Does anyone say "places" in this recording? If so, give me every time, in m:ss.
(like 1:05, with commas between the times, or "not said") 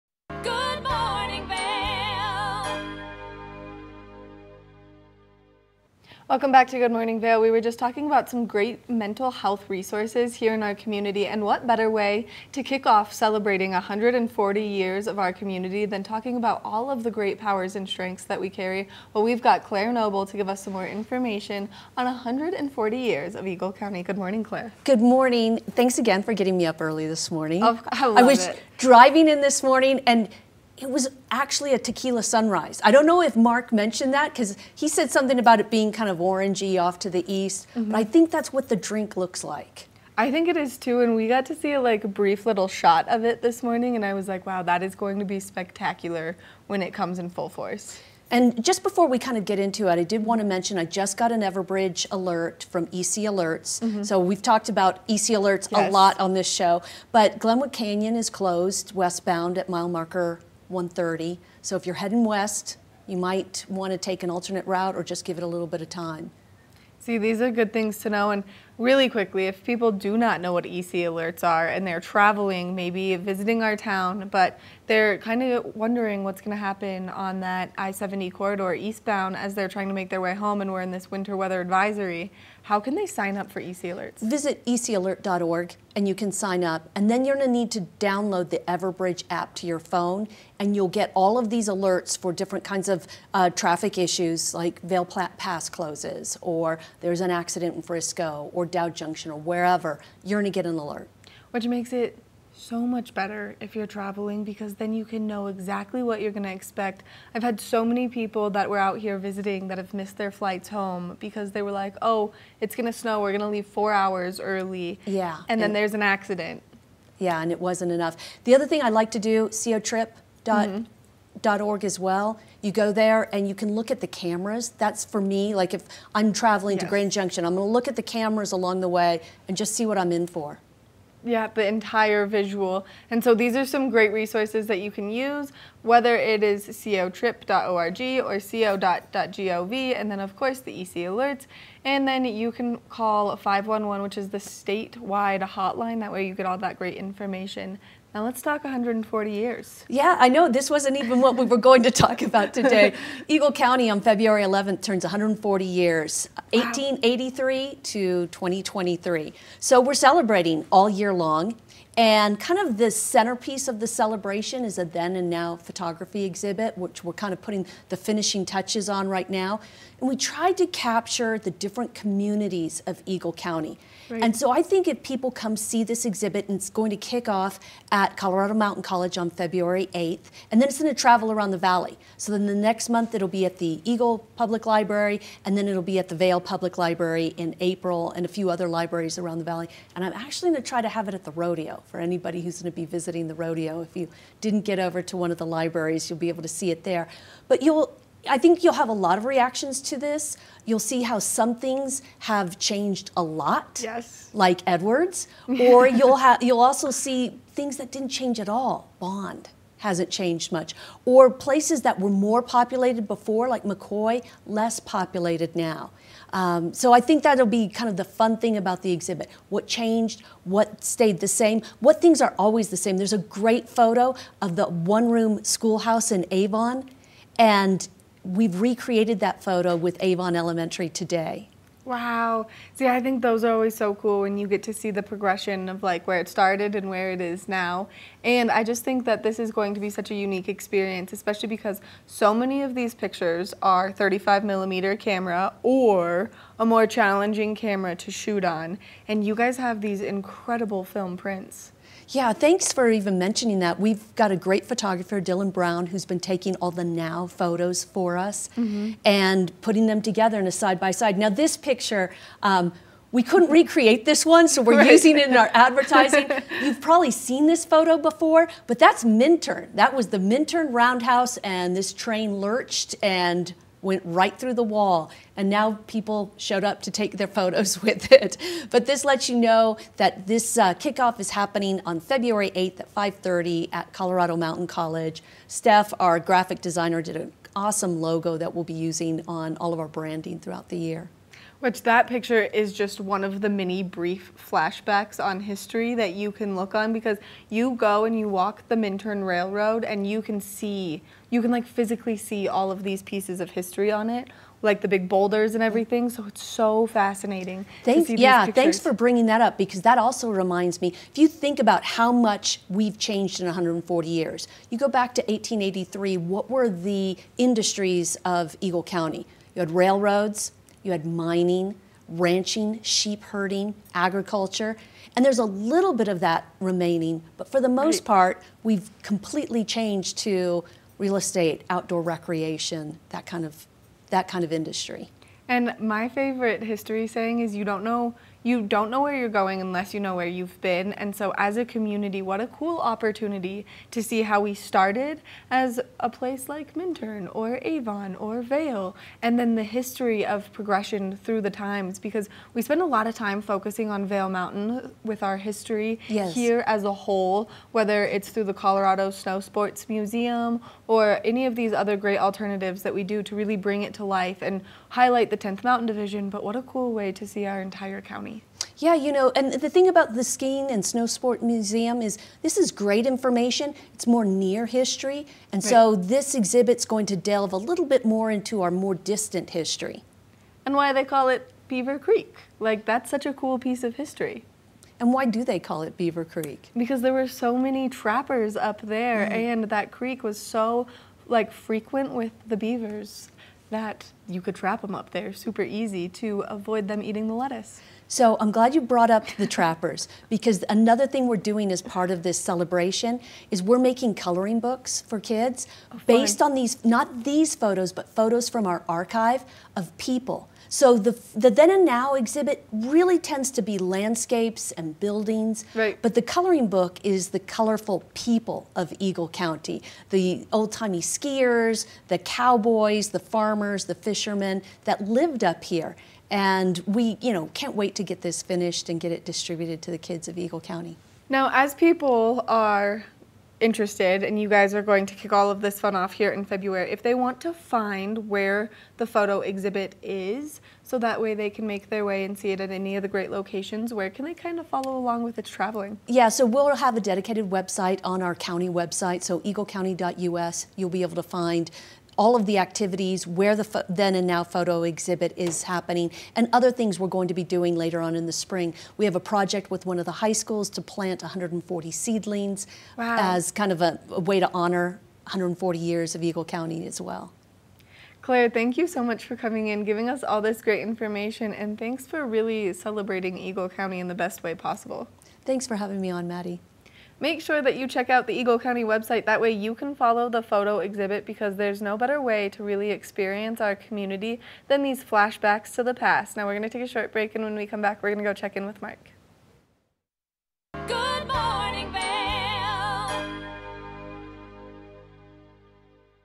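3:31, 5:46.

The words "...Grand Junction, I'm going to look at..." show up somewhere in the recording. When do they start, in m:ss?
2:06.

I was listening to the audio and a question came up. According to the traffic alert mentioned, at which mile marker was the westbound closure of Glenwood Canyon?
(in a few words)
130.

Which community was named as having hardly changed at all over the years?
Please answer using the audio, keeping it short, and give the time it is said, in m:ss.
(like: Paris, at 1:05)
Bond, at 3:28.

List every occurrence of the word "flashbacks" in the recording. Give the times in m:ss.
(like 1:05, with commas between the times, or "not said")
4:54, 8:05.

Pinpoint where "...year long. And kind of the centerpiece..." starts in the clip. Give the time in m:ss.
2:40.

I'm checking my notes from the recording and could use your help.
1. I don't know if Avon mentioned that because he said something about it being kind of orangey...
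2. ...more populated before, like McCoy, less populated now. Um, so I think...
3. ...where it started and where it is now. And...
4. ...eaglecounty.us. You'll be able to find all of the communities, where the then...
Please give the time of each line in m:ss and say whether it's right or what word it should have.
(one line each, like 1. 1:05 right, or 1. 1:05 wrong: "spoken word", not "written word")
1. 0:32 wrong: "Mark", not "Avon"
2. 3:32 right
3. 3:56 right
4. 7:29 wrong: "activities", not "communities".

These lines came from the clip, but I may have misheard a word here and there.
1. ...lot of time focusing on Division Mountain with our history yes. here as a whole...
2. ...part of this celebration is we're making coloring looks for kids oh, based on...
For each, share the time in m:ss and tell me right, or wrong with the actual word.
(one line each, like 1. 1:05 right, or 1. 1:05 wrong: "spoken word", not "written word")
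1. 5:52 wrong: "Vail", not "Division"
2. 6:41 wrong: "books", not "looks".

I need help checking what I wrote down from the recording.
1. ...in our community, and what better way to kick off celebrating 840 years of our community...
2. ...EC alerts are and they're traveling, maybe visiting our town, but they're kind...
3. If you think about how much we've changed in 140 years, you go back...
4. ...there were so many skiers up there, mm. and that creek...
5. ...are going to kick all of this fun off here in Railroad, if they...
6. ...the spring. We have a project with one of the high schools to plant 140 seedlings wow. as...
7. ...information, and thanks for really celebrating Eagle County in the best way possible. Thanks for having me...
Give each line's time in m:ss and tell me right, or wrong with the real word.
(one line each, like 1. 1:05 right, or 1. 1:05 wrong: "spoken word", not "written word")
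1. 0:10 wrong: "140", not "840"
2. 1:10 right
3. 5:11 right
4. 6:27 wrong: "trappers", not "skiers"
5. 7:14 wrong: "February", not "Railroad"
6. 7:38 right
7. 7:50 right.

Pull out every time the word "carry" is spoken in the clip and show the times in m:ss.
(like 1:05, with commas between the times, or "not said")
0:18.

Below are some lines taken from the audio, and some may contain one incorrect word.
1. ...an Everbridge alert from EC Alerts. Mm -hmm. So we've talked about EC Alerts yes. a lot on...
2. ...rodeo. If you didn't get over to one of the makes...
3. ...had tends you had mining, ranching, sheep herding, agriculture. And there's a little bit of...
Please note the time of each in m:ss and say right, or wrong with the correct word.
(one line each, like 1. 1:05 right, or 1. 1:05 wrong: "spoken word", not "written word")
1. 0:51 right
2. 3:13 wrong: "libraries", not "makes"
3. 5:19 wrong: "railroads", not "tends".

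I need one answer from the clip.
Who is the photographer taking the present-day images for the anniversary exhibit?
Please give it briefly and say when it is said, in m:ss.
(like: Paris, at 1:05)
Dylan Brown, at 4:15.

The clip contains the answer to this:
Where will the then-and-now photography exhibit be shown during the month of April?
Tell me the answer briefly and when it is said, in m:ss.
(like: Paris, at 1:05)
Vail Public Library, at 3:06.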